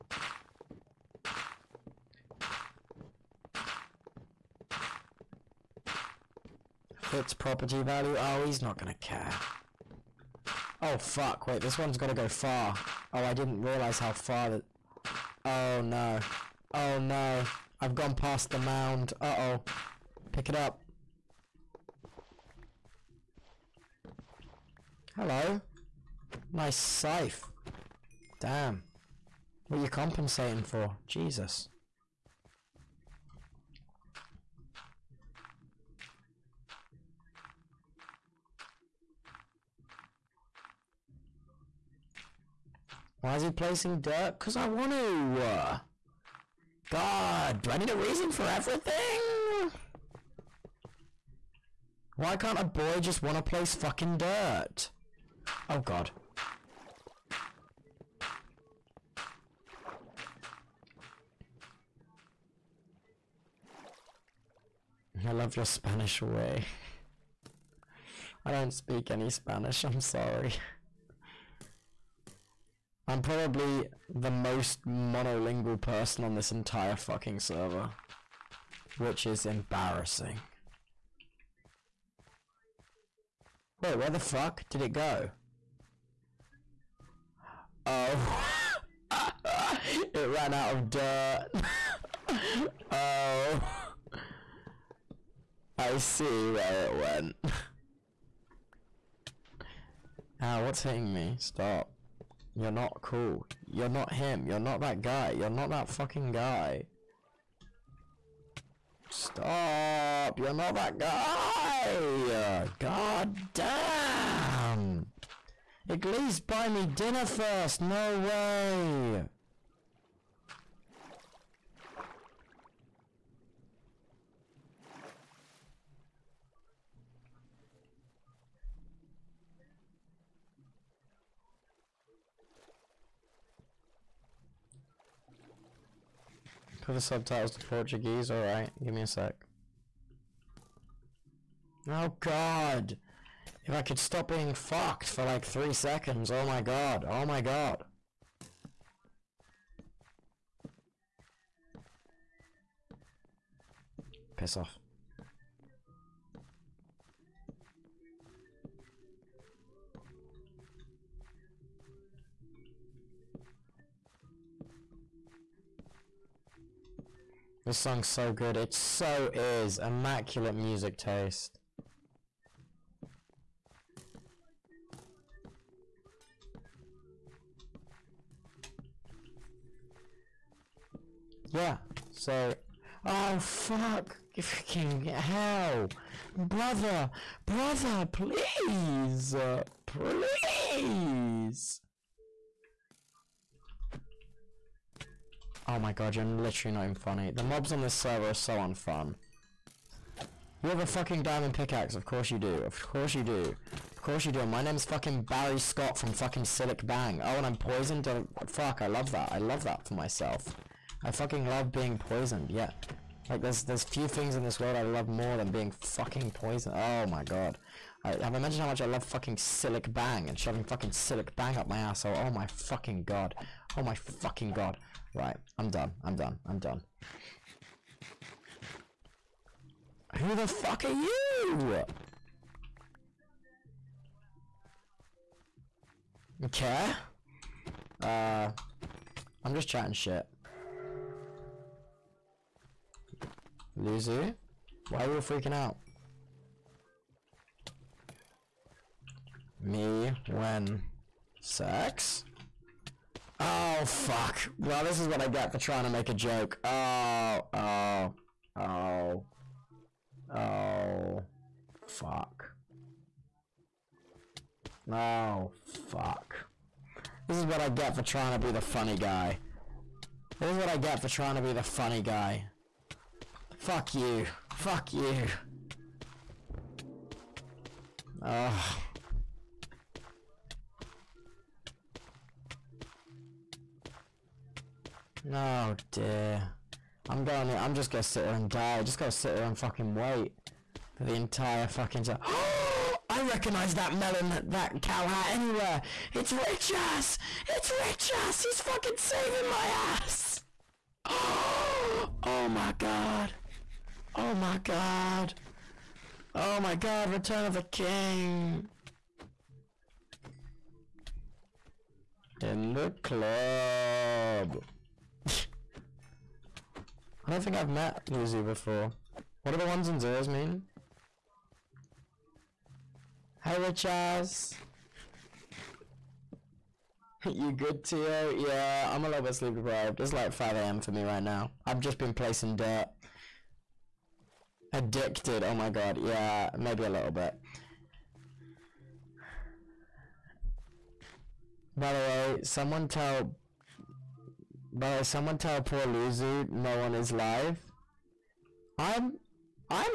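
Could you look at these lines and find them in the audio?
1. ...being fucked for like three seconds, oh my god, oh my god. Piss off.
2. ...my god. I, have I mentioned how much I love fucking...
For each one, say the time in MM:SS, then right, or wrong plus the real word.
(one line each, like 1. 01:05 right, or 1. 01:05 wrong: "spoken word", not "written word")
1. 02:24 right
2. 03:37 right.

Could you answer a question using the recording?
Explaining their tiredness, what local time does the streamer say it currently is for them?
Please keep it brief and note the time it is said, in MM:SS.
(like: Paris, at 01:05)
5 a.m., at 05:29.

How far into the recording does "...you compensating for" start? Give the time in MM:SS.
00:29.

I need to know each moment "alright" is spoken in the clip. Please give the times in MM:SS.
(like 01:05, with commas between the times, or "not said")
02:18.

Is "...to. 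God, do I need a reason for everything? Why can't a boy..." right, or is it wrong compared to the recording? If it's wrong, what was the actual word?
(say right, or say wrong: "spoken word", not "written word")
right.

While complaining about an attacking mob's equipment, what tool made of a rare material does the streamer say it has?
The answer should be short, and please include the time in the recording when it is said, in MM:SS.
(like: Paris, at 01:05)
diamond pickaxe, at 03:20.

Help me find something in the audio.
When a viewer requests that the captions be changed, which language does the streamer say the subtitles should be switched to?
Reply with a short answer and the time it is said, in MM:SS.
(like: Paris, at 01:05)
Portuguese, at 02:16.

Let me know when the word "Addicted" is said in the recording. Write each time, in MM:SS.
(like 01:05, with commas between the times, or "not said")
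05:34.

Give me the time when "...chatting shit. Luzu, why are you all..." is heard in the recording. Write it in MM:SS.
03:59.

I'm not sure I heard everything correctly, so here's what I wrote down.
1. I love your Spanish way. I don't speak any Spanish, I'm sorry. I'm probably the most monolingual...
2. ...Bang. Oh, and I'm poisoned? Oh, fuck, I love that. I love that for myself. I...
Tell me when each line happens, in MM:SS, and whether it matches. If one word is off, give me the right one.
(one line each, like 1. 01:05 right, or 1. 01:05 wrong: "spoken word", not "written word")
1. 01:05 right
2. 03:26 right.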